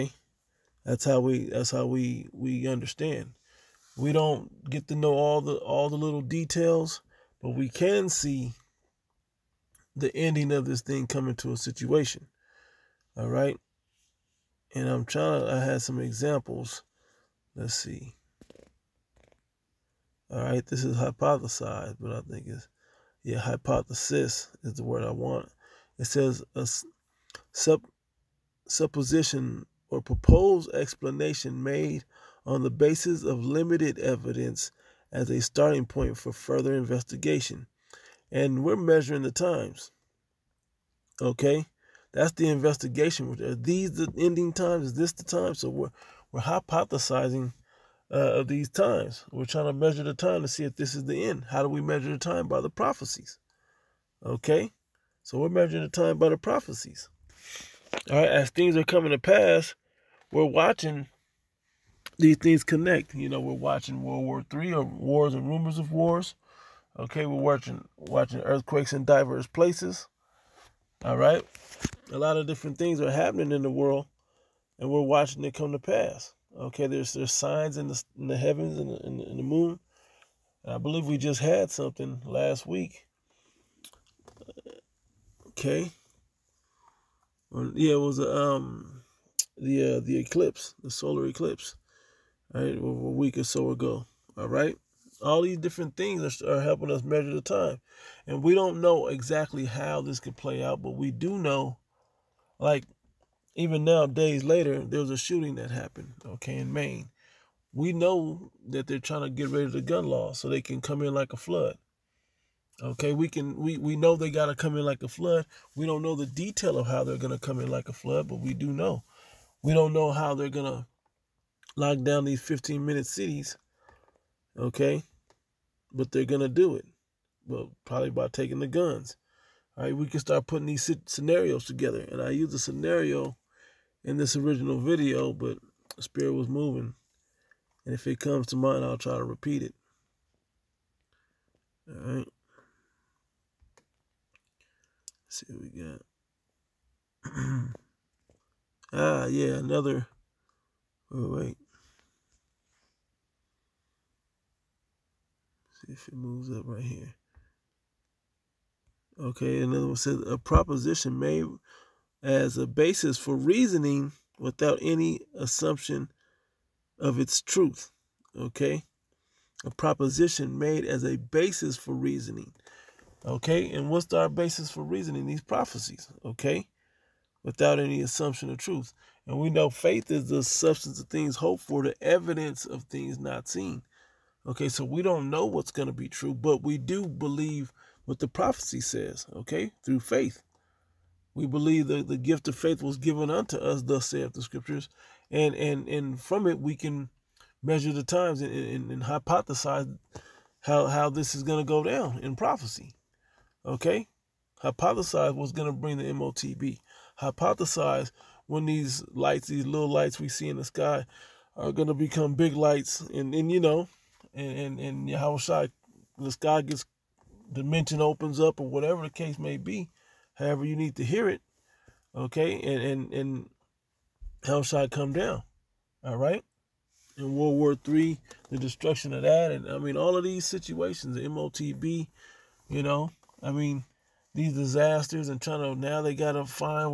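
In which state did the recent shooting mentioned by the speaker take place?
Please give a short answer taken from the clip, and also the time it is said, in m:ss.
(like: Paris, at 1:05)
Maine, at 1:46.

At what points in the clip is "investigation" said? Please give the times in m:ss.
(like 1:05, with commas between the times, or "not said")
0:36, 0:42.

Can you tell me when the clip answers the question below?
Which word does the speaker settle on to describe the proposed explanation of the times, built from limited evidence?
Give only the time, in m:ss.
0:23.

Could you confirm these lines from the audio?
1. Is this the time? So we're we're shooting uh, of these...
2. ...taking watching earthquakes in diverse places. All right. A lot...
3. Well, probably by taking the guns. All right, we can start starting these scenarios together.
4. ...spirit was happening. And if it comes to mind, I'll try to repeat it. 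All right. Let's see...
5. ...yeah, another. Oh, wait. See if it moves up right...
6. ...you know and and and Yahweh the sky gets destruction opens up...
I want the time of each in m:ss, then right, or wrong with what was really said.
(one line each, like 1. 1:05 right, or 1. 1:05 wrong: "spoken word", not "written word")
1. 0:44 wrong: "hypothesizing", not "shooting"
2. 1:07 wrong: "watching", not "taking"
3. 2:07 wrong: "putting", not "starting"
4. 2:15 wrong: "moving", not "happening"
5. 2:29 right
6. 3:33 wrong: "dimension", not "destruction".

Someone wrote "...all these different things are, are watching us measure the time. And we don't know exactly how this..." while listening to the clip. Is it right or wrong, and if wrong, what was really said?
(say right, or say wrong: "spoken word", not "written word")
wrong: "helping", not "watching".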